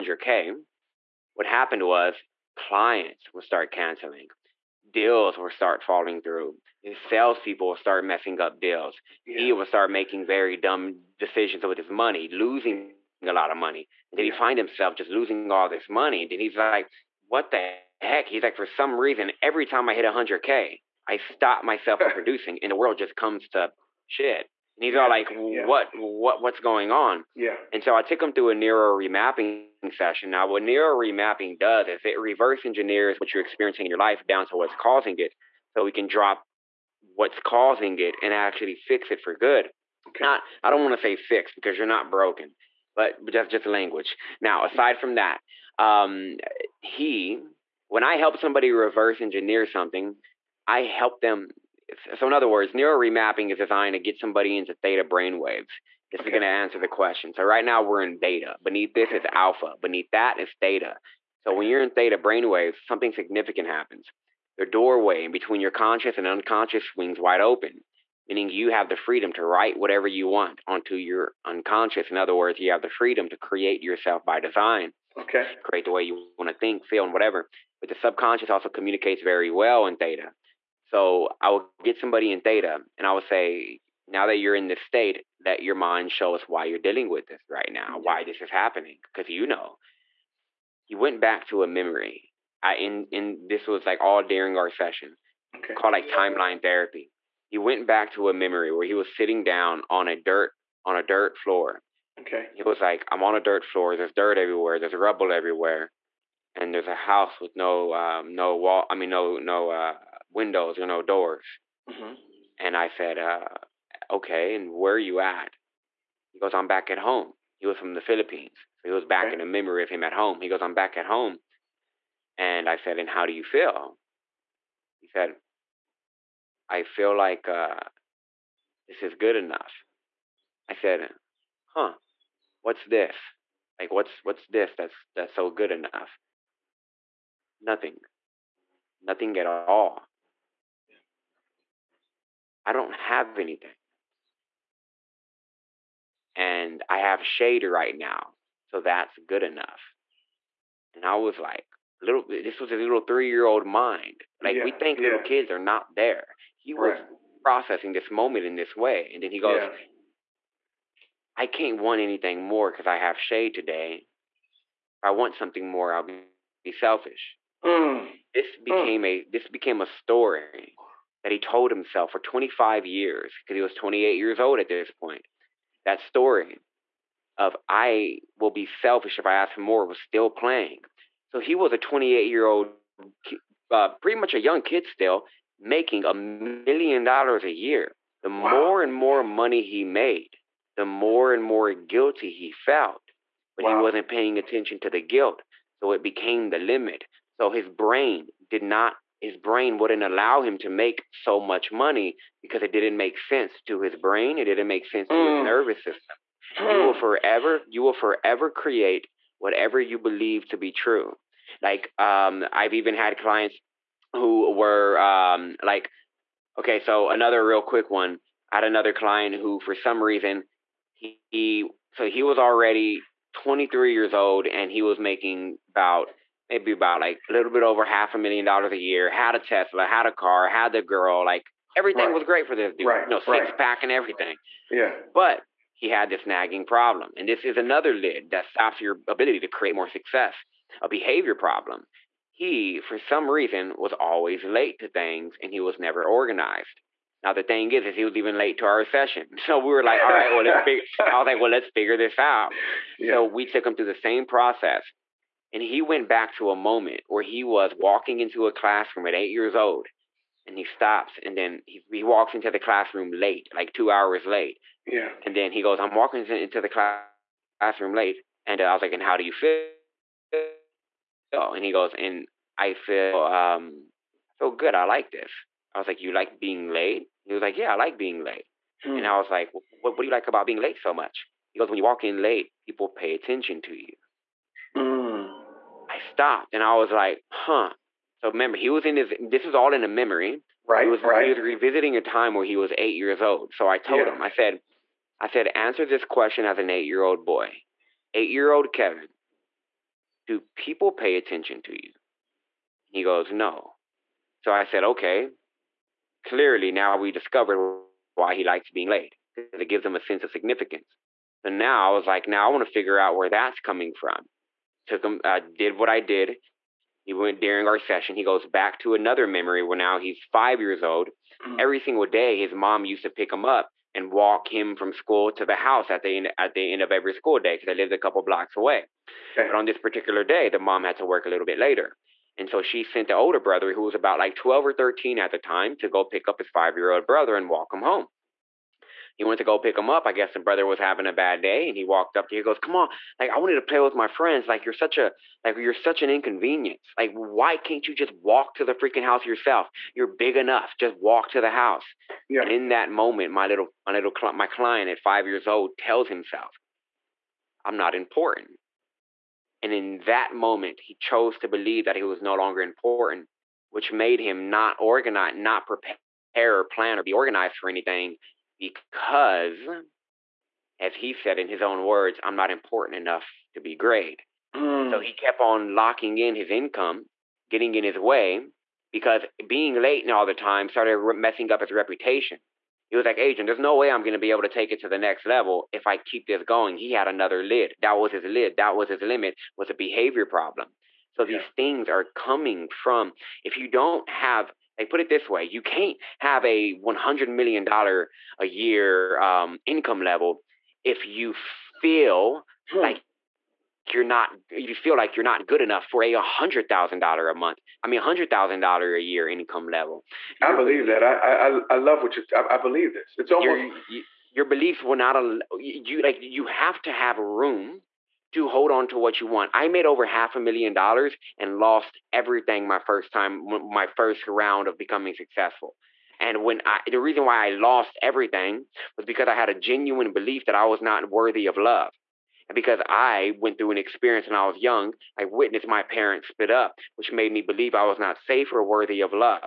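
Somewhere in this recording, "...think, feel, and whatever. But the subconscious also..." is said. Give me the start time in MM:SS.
01:16.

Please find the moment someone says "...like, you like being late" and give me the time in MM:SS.
04:35.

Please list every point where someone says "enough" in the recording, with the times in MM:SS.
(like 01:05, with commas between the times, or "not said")
02:09, 02:15, 02:29, 05:50, 06:12, 06:45.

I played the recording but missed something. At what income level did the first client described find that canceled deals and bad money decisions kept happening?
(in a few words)
100K.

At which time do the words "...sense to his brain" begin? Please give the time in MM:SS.
03:23.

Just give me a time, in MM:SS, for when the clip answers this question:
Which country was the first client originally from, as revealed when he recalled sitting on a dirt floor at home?
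01:58.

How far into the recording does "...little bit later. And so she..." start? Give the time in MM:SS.
05:31.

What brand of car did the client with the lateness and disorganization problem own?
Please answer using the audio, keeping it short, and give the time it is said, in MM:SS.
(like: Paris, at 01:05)
Tesla, at 03:49.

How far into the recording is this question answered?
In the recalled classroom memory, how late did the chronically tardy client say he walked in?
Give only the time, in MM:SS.
04:23.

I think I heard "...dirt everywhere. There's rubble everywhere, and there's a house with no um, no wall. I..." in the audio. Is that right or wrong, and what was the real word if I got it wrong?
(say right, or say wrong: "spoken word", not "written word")
right.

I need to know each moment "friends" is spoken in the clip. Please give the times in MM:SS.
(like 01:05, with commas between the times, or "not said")
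05:44.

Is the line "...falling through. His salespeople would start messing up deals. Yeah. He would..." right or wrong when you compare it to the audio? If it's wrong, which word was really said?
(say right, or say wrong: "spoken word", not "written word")
right.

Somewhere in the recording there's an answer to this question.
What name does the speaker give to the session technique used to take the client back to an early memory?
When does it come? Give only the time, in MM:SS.
01:36.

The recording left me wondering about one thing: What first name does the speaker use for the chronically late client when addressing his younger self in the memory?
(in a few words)
Kevin.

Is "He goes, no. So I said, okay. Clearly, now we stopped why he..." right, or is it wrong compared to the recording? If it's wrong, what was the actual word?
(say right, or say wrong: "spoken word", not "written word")
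wrong: "discovered", not "stopped".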